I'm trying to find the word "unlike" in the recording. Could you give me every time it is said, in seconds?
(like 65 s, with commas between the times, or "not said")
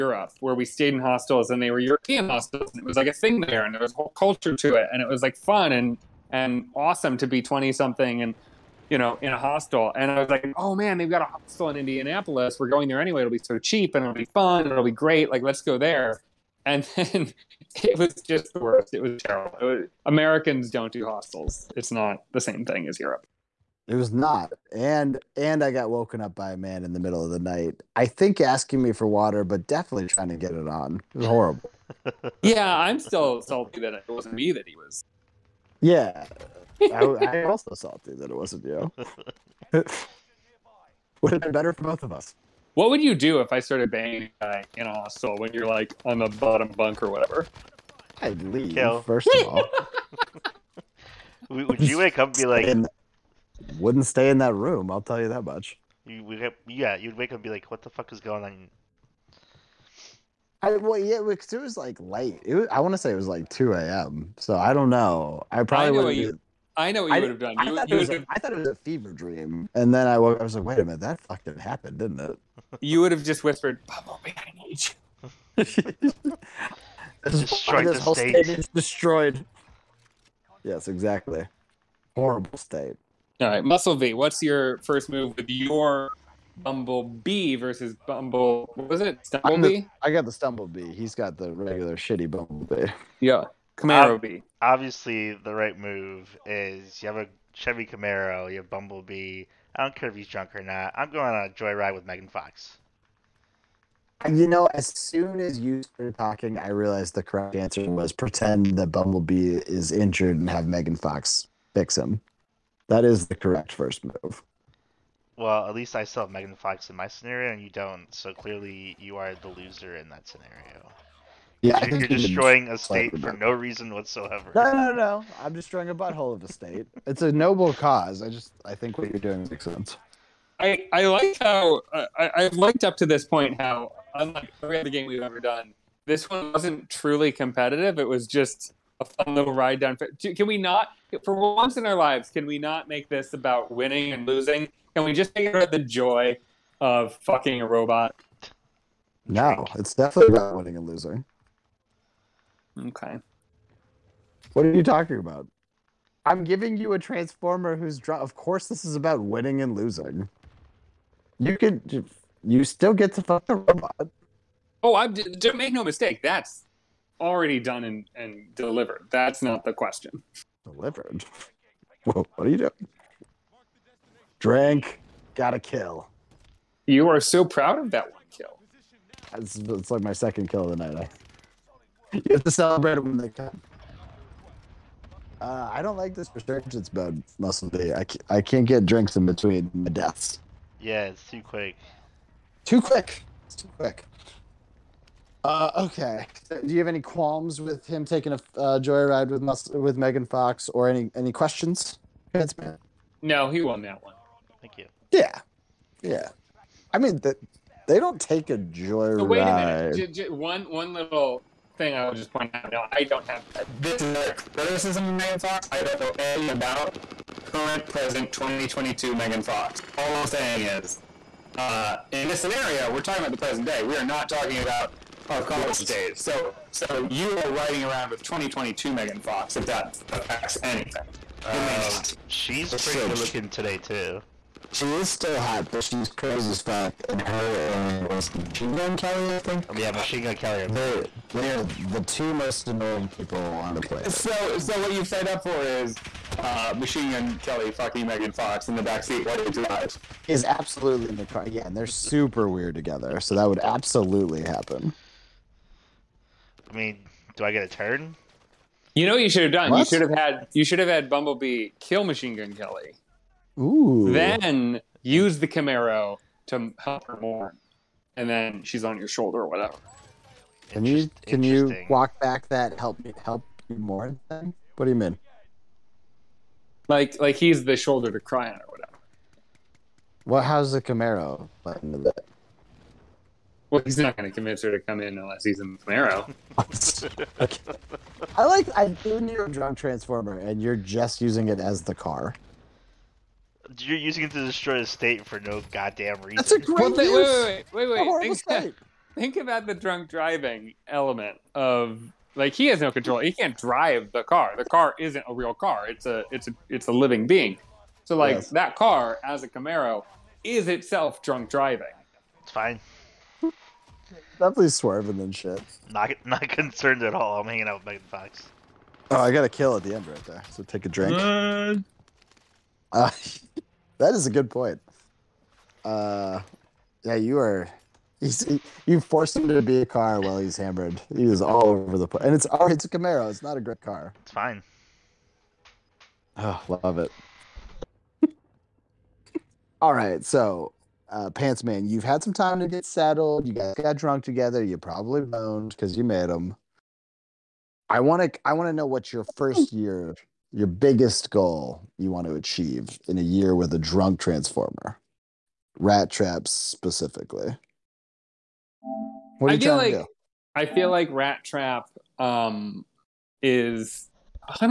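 134 s.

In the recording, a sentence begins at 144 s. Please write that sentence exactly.
Can we just it about the joy of fucking a robot?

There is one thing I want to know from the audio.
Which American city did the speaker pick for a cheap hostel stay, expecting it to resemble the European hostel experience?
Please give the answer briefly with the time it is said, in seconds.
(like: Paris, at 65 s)
Indianapolis, at 11 s.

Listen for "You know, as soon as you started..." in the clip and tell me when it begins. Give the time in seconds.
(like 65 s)
104 s.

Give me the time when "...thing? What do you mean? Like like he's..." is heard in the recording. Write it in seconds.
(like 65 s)
274 s.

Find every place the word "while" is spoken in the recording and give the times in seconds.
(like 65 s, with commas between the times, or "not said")
249 s, 330 s.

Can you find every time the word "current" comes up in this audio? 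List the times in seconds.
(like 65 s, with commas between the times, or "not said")
217 s.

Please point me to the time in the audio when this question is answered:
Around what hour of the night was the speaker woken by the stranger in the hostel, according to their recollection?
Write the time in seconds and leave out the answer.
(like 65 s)
63 s.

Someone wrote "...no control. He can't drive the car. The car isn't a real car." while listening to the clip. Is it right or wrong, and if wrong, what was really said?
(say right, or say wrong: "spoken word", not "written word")
right.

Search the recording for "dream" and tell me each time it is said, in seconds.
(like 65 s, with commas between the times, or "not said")
69 s.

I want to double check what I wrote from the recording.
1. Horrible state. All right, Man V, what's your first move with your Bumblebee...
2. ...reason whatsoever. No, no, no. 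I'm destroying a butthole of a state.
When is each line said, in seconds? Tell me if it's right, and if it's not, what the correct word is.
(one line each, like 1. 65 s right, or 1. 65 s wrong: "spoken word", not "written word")
1. 82 s wrong: "Muscle", not "Man"
2. 123 s right.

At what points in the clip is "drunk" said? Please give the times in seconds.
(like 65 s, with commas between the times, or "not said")
100 s, 289 s, 299 s, 311 s, 343 s, 353 s.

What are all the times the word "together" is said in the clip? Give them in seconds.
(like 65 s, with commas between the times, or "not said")
252 s, 344 s.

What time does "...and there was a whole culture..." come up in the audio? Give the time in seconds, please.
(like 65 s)
3 s.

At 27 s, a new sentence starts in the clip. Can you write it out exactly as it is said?
I think asking me for water, but definitely trying to get it on.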